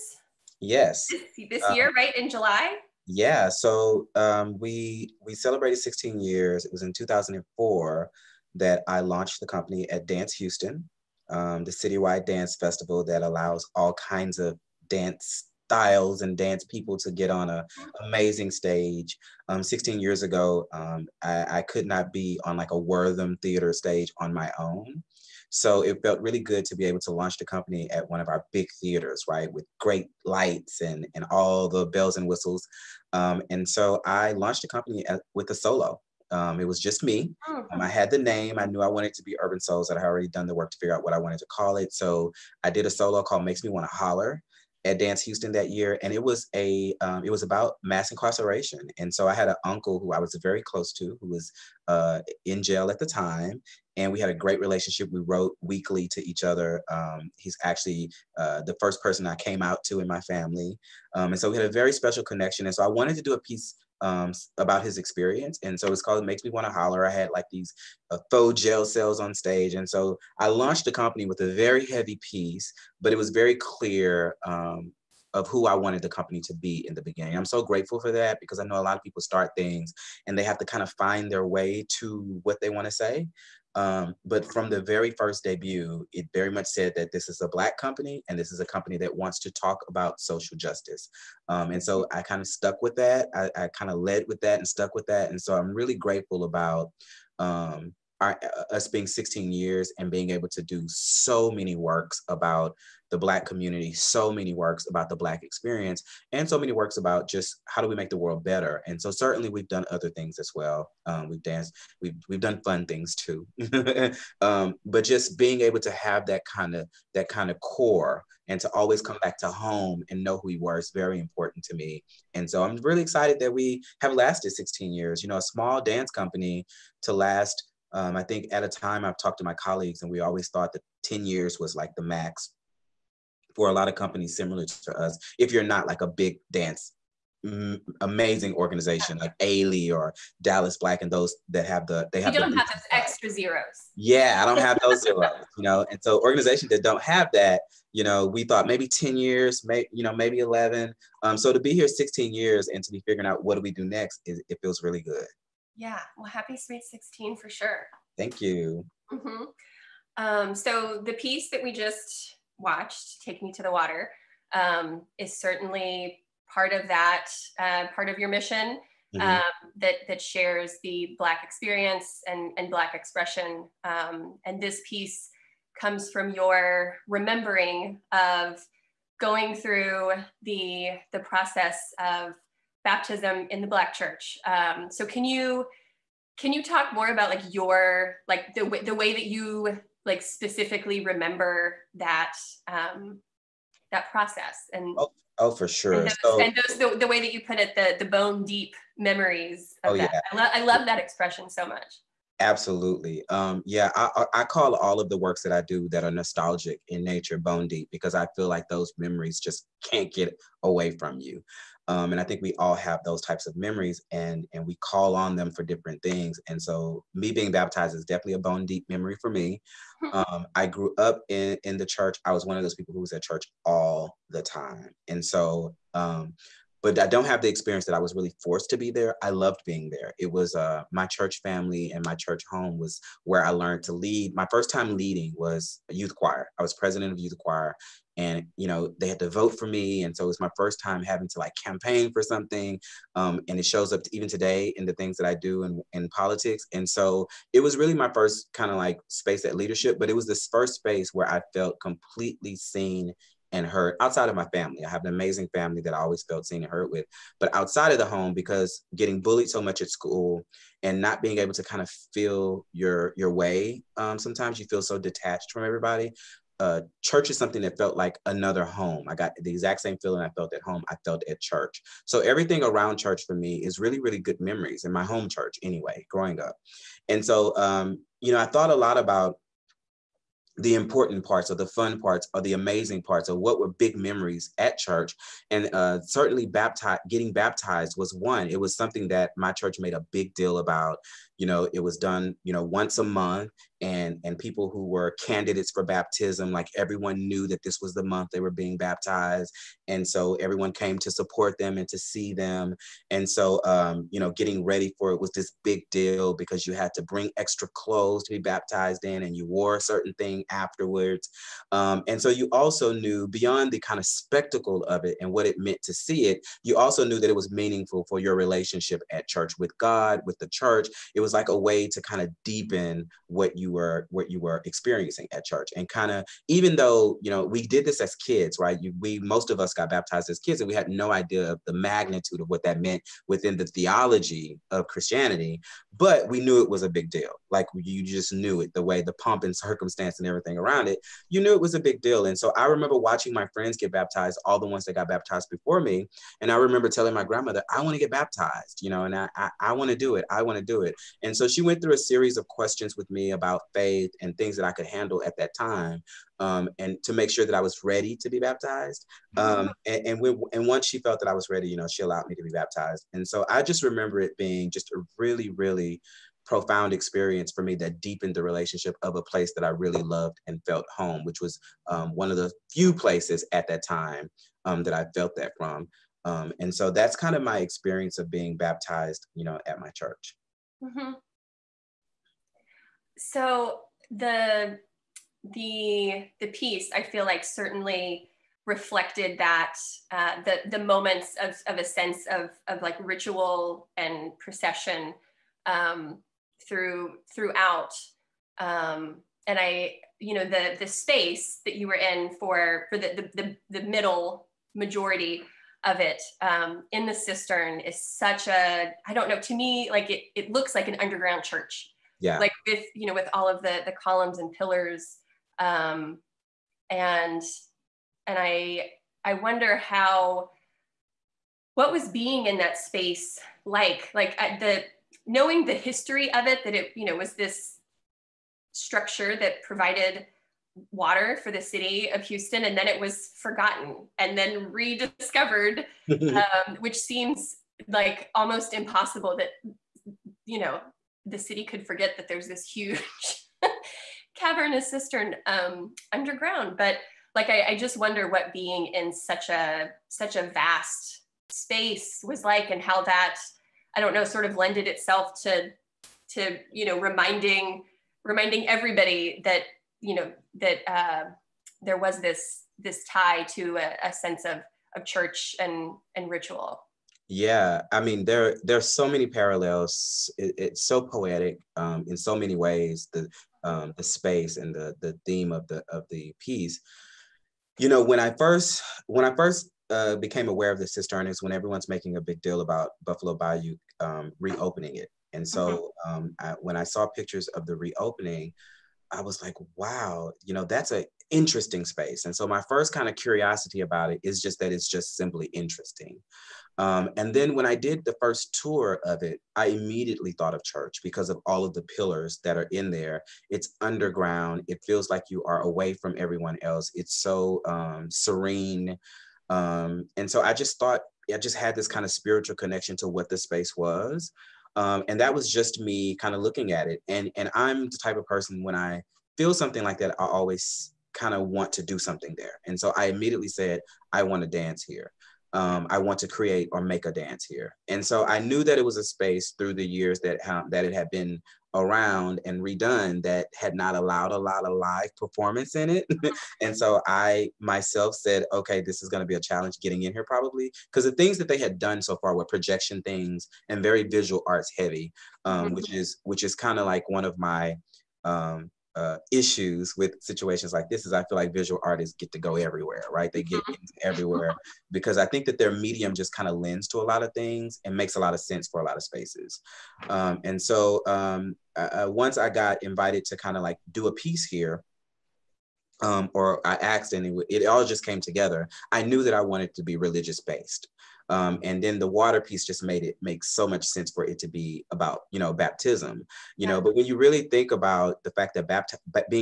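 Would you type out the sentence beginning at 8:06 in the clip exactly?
um, I, when i saw pictures of the reopening I was like, wow, you know, that's an interesting space.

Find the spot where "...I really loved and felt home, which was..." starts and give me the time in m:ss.
6:09.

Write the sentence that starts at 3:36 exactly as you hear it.
And so me being baptized is definitely a bone deep memory for me.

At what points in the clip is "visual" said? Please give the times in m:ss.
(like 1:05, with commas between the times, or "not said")
9:04, 9:11.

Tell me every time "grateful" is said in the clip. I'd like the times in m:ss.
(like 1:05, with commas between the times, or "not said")
1:17, 1:35.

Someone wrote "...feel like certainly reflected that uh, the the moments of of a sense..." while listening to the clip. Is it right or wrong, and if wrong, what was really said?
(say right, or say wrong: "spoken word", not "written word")
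right.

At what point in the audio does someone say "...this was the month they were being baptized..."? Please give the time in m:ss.
4:57.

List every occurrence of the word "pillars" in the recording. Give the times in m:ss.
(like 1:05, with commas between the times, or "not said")
6:54, 8:21.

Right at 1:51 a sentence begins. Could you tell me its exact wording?
Um, we've danced, we've, we've done fun things too.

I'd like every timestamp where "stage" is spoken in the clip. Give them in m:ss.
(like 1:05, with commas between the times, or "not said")
0:18, 0:23, 1:09.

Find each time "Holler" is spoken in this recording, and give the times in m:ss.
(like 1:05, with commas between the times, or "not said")
0:43, 1:06.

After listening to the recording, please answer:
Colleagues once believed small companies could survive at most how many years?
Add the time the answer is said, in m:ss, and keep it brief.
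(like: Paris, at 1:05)
10, at 2:11.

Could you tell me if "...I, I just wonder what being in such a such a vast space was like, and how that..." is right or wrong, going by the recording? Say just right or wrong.
right.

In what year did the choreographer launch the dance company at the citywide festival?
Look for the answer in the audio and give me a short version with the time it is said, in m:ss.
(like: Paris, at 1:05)
2004, at 0:06.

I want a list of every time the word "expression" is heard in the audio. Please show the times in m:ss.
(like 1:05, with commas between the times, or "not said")
2:52, 3:20.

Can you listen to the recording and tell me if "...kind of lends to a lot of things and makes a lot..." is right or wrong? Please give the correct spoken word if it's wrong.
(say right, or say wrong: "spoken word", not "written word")
right.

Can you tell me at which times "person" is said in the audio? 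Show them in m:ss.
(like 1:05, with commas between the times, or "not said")
0:59, 8:38.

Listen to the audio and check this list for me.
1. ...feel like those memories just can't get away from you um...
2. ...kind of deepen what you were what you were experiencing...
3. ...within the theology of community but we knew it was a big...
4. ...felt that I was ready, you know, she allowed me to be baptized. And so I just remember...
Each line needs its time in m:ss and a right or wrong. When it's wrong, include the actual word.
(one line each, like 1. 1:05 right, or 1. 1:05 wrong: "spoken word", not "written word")
1. 3:28 right
2. 5:22 right
3. 5:33 wrong: "christianity", not "community"
4. 6:00 right.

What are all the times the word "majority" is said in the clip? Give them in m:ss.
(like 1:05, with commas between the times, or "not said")
6:44.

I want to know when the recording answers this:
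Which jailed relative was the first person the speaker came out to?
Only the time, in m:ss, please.
0:49.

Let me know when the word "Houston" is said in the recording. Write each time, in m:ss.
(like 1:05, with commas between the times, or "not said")
0:10, 0:45, 7:12.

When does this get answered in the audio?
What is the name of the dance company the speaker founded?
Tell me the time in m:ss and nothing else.
0:39.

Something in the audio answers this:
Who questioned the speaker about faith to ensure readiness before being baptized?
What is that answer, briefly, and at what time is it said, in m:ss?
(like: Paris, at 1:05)
grandmother, at 5:47.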